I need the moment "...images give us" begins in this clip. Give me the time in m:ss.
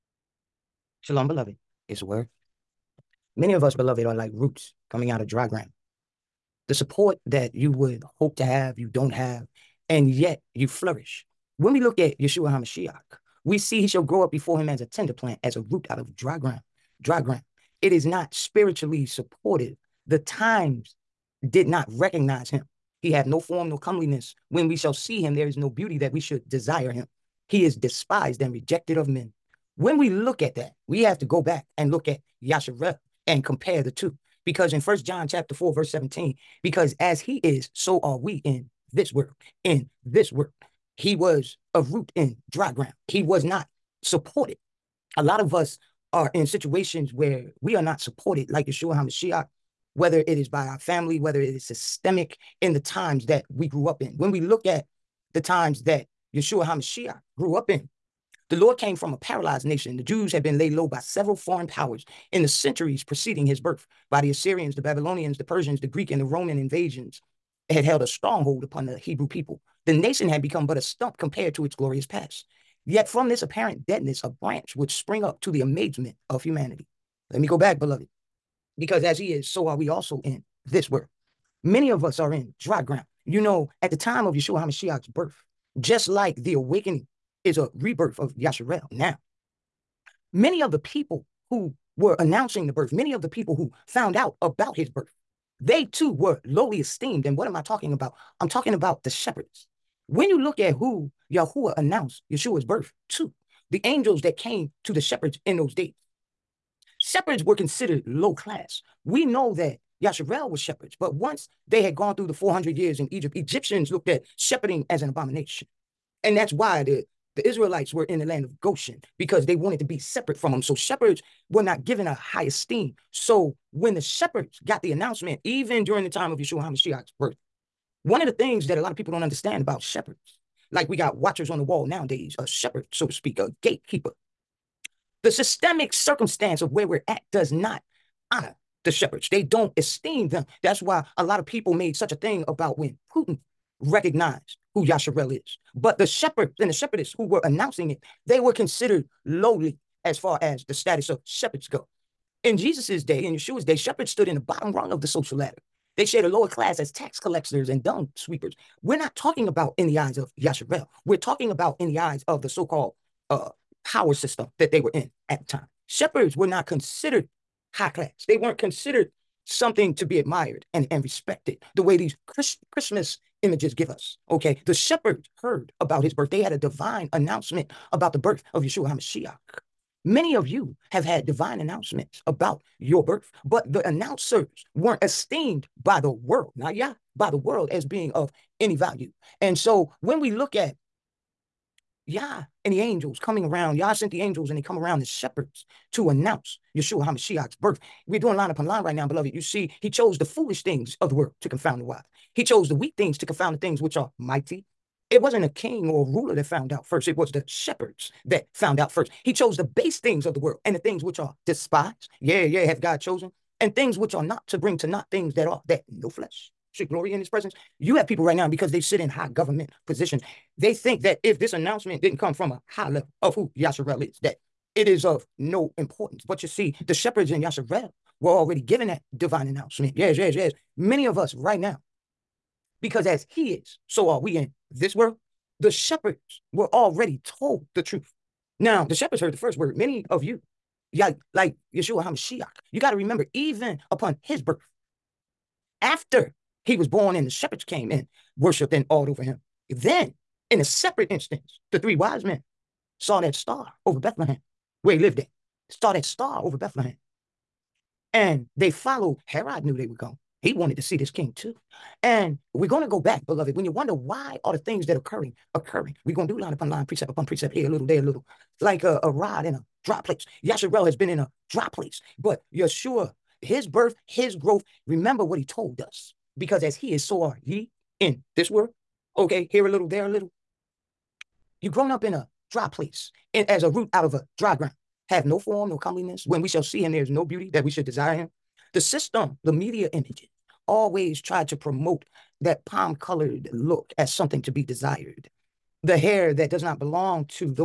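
2:53.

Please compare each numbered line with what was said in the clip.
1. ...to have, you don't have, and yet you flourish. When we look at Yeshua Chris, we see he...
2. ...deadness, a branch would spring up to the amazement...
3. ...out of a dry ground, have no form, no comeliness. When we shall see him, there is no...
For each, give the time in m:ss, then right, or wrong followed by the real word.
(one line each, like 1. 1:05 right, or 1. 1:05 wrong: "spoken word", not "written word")
1. 0:08 wrong: "HaMashiach", not "Chris"
2. 1:13 right
3. 4:43 right.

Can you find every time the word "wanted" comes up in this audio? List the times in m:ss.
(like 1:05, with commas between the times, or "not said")
1:59, 4:20.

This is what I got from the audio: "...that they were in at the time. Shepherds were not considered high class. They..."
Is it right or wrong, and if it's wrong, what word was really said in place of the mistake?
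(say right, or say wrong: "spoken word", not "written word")
right.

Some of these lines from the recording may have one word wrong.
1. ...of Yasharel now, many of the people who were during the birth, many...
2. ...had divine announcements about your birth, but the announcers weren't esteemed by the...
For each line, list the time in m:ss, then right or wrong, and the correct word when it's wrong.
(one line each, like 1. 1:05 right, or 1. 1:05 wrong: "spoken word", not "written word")
1. 1:28 wrong: "announcing", not "during"
2. 3:01 right.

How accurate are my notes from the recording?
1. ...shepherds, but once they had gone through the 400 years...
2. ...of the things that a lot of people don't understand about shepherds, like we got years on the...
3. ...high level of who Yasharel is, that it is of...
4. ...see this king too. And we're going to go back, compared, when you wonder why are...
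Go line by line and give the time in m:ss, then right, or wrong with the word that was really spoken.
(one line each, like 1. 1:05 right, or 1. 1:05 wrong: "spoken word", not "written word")
1. 1:50 right
2. 2:08 wrong: "watchers", not "years"
3. 3:42 right
4. 4:20 wrong: "beloved", not "compared".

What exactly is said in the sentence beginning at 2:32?
In Jesus's day, in Yeshua's day, shepherds stood in the bottom rung of the social ladder.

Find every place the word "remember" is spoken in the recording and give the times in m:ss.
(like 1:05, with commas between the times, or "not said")
4:02, 4:34.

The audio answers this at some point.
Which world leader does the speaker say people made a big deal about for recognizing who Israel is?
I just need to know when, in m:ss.
2:23.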